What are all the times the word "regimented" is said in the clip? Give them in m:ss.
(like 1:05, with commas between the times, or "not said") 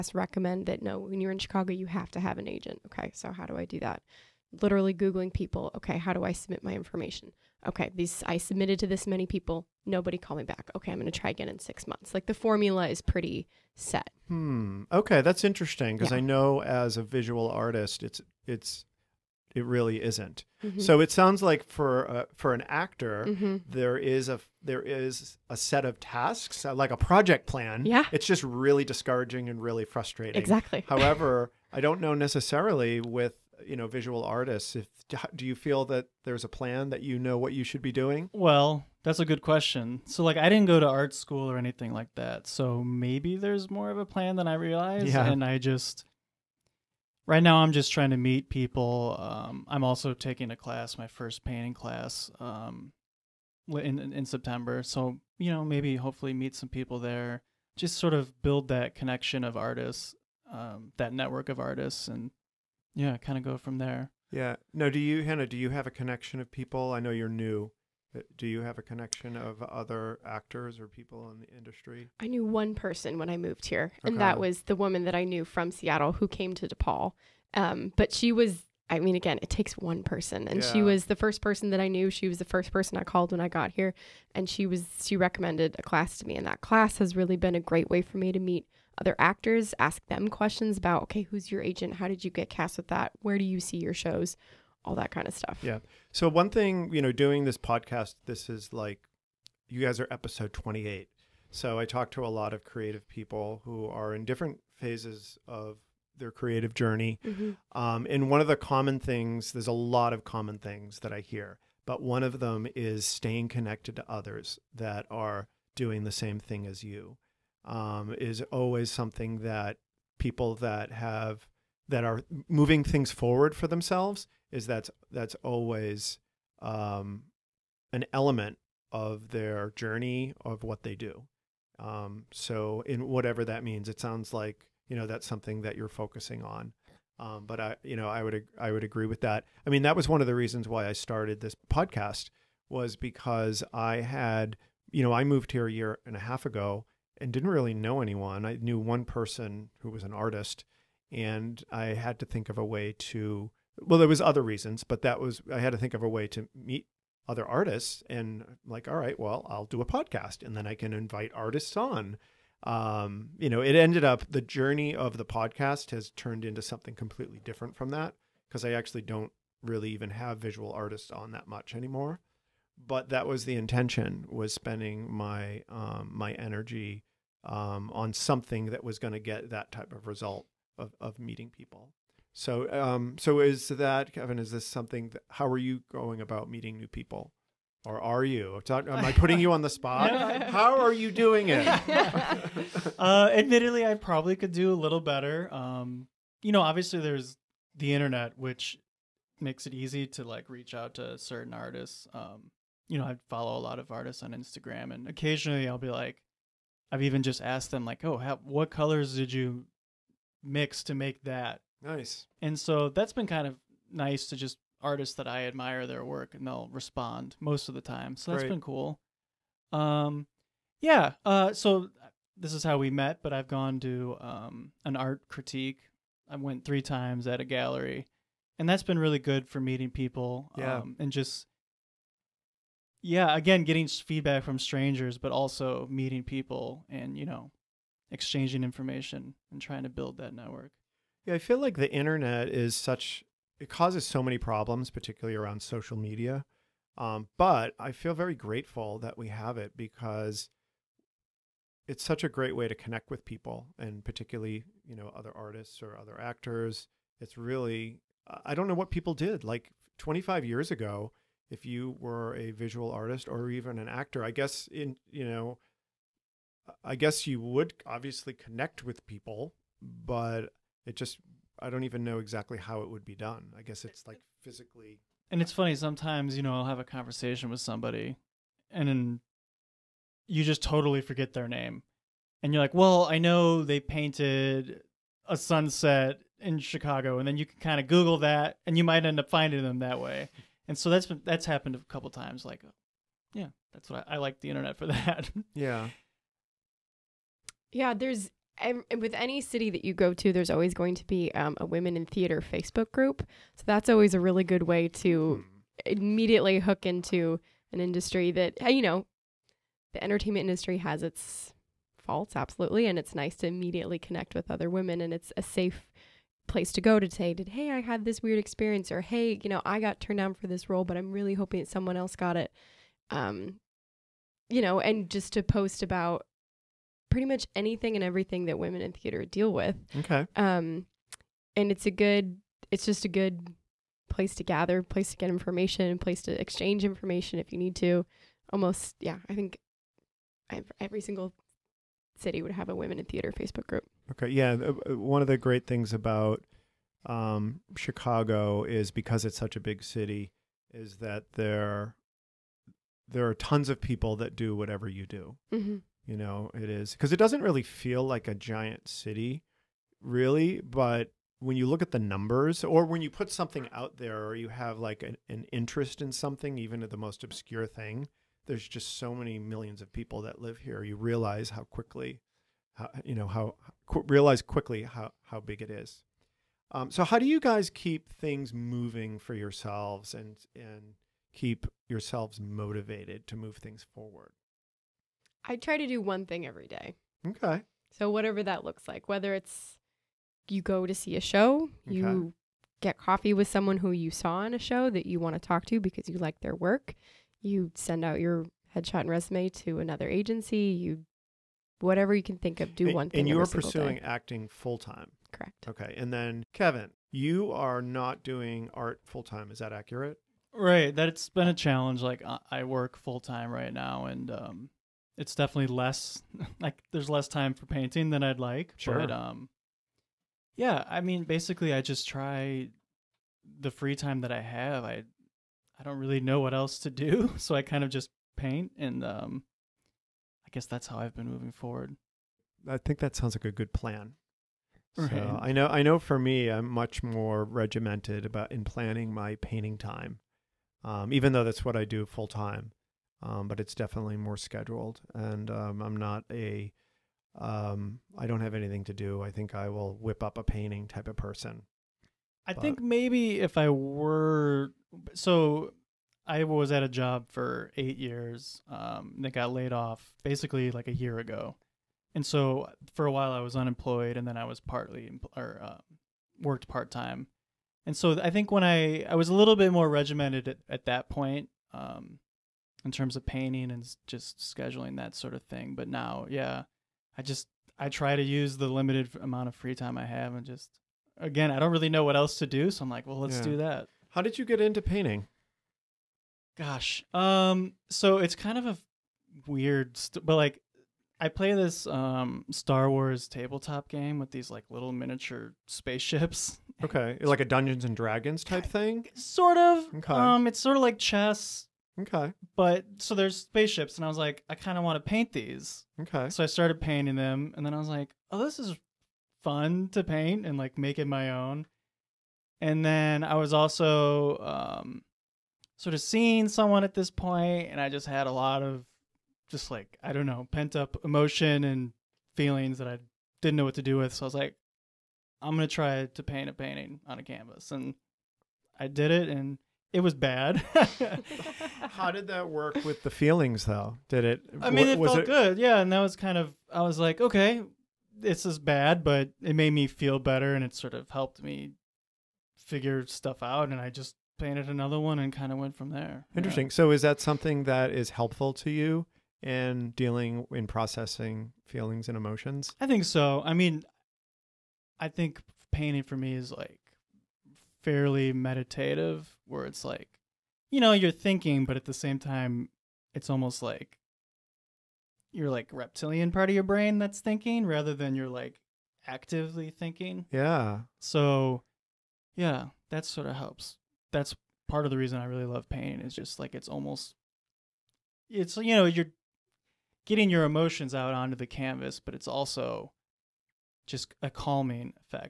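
7:17, 7:49.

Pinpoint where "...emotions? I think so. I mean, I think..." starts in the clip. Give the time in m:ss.
9:12.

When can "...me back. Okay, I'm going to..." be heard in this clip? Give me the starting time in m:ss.
0:10.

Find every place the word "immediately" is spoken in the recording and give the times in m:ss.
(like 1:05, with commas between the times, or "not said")
5:05, 5:13.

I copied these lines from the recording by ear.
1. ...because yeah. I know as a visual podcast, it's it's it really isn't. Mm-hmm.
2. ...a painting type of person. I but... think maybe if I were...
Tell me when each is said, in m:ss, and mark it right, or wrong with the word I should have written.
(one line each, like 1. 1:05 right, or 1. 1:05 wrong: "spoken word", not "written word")
1. 0:15 wrong: "artist", not "podcast"
2. 7:30 right.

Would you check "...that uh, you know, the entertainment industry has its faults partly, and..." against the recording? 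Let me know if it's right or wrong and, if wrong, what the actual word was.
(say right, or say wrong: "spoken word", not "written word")
wrong: "absolutely", not "partly".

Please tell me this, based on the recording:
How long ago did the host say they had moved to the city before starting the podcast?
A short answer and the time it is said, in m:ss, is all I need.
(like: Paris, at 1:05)
A year and a half, at 2:25.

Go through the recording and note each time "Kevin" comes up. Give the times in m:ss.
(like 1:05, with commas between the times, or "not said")
3:04, 6:46.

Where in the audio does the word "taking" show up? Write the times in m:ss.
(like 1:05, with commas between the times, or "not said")
0:50.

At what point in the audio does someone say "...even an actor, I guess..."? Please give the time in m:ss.
4:23.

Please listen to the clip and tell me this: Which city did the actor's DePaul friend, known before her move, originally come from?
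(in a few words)
Seattle.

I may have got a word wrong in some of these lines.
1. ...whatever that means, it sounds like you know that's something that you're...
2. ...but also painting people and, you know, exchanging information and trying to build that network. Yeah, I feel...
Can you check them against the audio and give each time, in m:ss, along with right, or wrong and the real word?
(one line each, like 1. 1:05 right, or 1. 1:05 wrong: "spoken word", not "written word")
1. 2:13 right
2. 3:55 wrong: "meeting", not "painting".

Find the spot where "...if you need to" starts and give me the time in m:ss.
5:37.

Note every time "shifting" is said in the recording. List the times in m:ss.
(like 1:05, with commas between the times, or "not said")
not said.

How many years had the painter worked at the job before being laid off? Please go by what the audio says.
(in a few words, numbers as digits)
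8.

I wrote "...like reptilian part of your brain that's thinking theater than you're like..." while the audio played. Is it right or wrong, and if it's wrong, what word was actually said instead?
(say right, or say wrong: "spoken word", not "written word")
wrong: "rather", not "theater".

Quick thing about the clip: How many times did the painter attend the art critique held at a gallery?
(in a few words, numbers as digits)
3.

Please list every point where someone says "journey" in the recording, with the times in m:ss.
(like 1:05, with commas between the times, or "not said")
1:46, 2:09, 2:44.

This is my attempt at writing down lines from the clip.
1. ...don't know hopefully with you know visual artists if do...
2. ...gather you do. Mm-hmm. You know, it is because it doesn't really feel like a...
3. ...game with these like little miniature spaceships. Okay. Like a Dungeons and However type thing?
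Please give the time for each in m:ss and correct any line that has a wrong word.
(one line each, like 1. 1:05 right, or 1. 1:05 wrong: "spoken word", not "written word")
1. 0:31 wrong: "necessarily", not "hopefully"
2. 5:54 wrong: "whatever", not "gather"
3. 8:13 wrong: "Dragons", not "However".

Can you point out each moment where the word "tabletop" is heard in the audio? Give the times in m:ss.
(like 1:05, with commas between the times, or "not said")
8:13.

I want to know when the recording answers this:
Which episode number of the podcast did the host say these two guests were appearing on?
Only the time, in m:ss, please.
1:40.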